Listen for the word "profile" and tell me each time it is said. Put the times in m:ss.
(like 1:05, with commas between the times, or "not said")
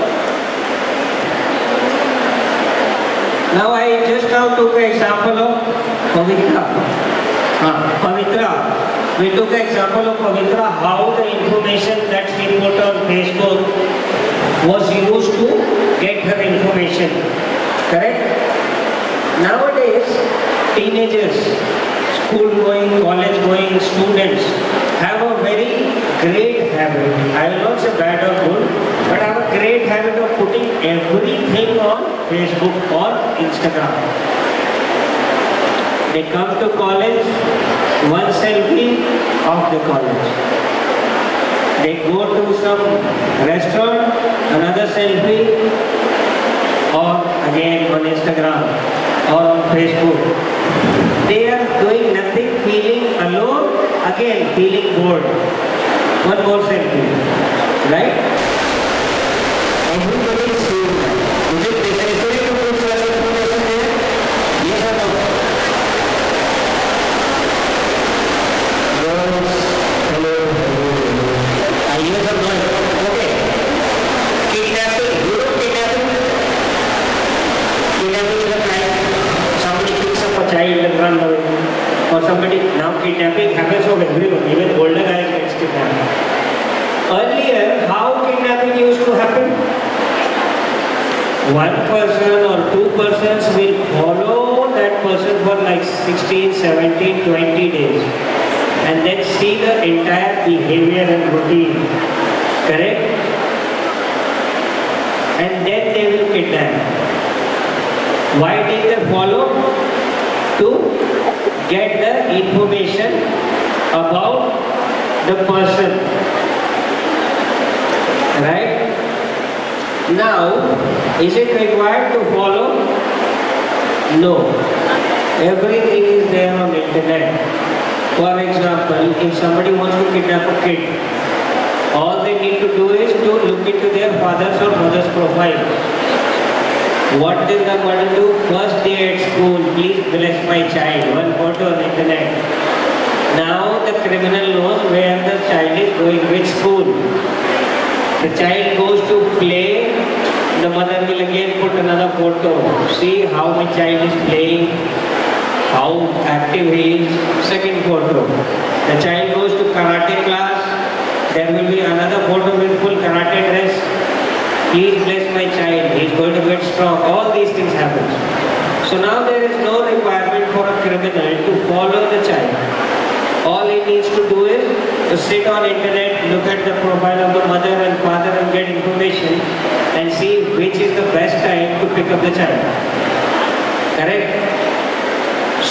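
2:15, 2:56.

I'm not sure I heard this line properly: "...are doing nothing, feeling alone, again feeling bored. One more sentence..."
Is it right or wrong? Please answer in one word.
right.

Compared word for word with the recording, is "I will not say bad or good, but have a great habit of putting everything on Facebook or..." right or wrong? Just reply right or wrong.
right.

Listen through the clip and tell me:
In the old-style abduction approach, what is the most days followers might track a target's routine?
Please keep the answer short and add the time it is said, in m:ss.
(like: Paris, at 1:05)
20, at 1:37.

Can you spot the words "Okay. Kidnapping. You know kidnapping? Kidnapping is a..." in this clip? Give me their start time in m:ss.
1:13.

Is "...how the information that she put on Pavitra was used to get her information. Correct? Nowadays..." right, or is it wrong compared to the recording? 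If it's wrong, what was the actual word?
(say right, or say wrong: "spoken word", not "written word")
wrong: "Facebook", not "Pavitra".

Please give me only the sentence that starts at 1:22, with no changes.
Or somebody, now kidnapping happens for everyone, even older guys gets kidnapped.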